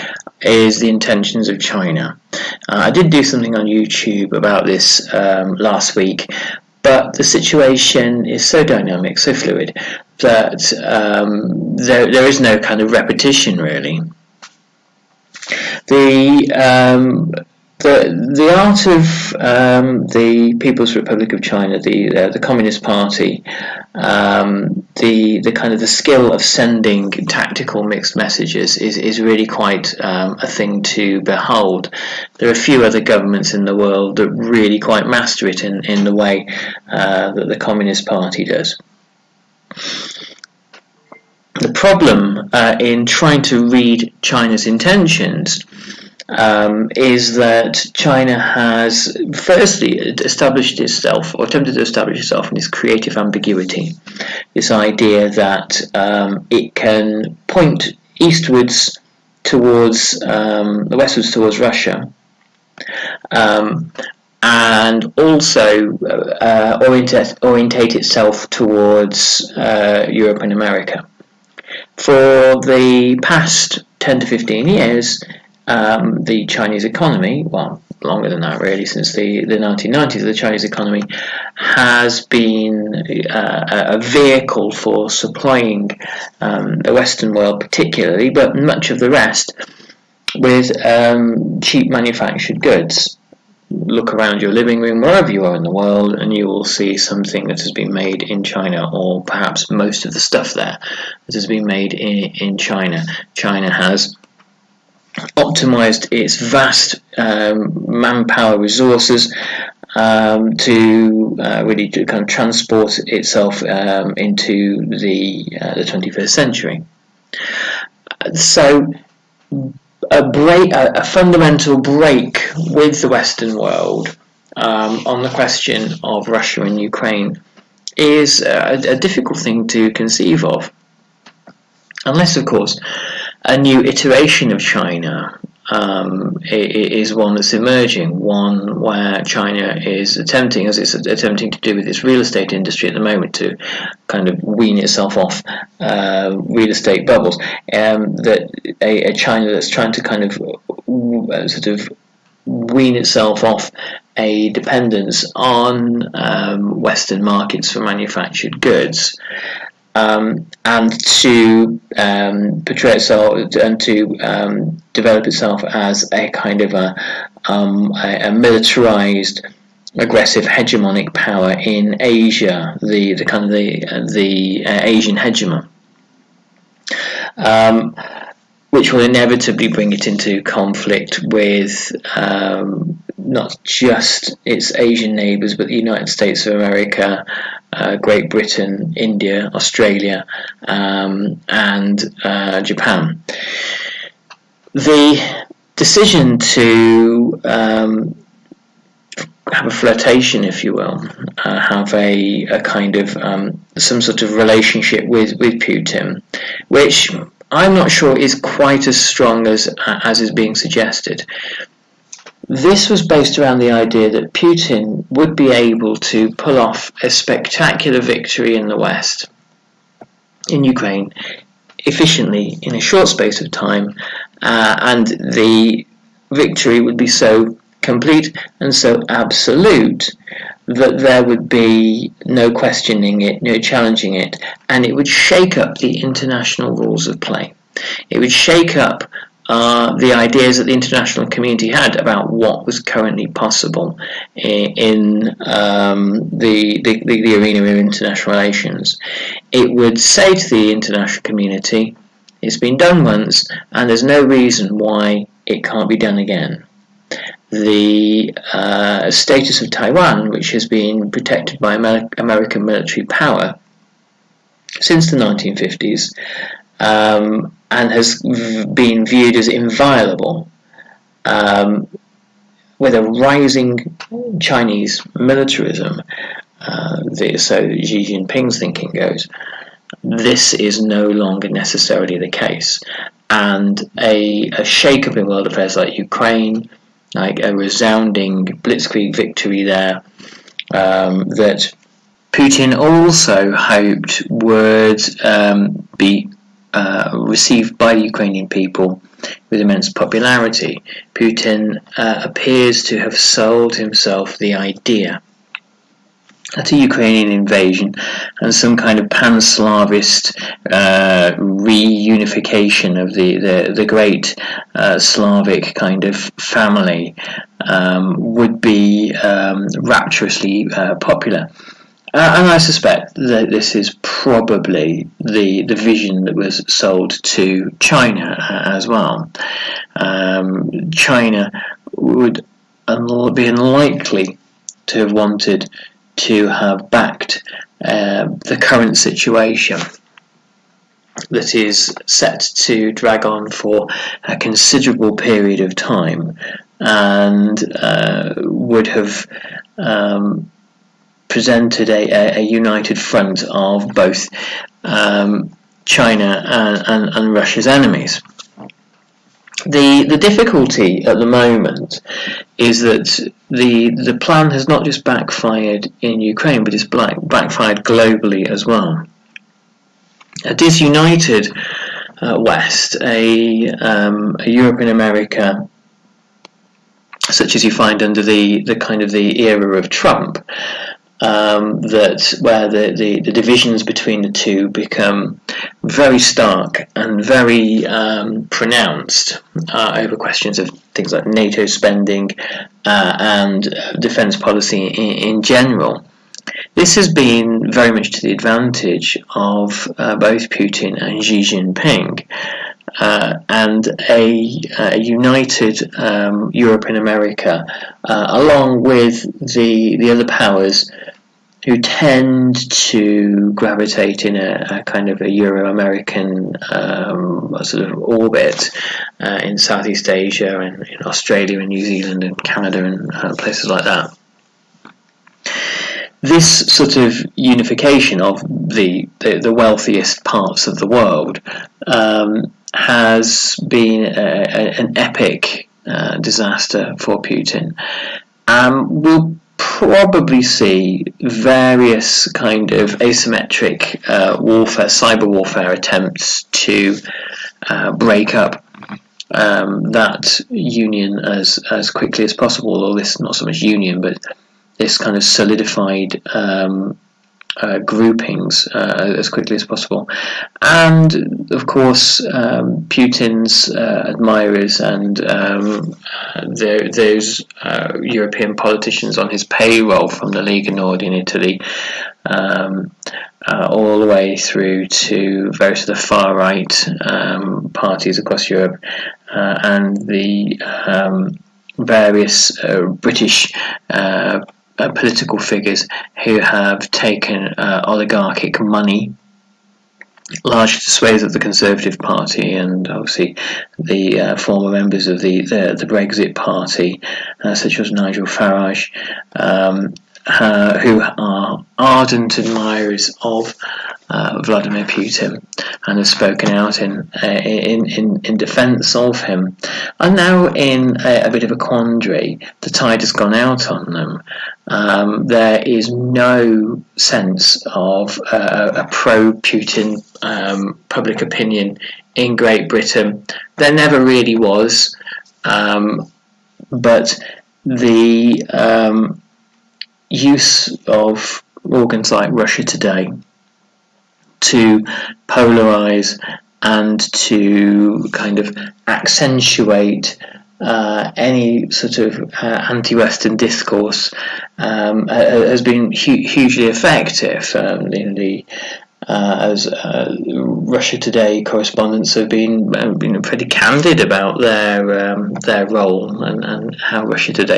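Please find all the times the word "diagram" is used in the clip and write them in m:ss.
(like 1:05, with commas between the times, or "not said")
not said.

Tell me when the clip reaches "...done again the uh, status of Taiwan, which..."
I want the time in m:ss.
4:15.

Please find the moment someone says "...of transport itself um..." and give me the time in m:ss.
1:52.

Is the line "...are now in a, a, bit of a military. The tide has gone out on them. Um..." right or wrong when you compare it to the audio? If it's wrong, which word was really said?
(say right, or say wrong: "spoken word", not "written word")
wrong: "quandary", not "military".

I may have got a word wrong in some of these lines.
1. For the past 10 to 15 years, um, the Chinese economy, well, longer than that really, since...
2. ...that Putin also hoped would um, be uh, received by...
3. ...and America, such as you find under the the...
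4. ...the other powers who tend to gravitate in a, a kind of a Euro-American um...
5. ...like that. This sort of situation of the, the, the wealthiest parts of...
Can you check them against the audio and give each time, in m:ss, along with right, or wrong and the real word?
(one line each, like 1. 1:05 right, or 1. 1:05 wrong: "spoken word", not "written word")
1. 1:11 right
2. 4:51 right
3. 6:14 right
4. 6:49 right
5. 7:03 wrong: "unification", not "situation".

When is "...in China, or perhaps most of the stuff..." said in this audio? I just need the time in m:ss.
1:38.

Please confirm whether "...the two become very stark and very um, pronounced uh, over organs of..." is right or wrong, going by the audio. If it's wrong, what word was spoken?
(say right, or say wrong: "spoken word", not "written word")
wrong: "questions", not "organs".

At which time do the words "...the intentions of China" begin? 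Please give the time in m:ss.
0:00.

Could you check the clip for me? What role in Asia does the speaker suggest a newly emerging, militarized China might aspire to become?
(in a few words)
Asian hegemon.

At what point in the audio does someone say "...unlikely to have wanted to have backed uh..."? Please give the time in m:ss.
5:33.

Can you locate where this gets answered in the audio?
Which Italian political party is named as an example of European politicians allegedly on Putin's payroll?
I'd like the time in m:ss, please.
7:50.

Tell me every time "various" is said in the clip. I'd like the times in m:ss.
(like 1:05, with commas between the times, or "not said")
7:21, 7:55, 8:01.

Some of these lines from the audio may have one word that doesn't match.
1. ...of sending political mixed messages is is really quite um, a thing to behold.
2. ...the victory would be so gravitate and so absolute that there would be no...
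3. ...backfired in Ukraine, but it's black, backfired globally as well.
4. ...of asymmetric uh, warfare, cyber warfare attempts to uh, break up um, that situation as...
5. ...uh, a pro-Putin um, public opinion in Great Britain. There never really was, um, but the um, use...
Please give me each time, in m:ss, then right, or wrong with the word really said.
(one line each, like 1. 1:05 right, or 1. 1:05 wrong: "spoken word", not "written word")
1. 0:26 wrong: "tactical", not "political"
2. 3:45 wrong: "complete", not "gravitate"
3. 6:05 right
4. 7:22 wrong: "union", not "situation"
5. 8:38 right.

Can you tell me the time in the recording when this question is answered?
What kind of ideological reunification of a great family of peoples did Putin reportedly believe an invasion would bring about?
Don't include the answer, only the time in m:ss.
5:09.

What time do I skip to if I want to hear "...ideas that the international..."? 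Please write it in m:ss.
4:00.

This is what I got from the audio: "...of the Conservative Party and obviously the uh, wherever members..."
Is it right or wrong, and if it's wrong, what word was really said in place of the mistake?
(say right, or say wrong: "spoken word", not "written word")
wrong: "former", not "wherever".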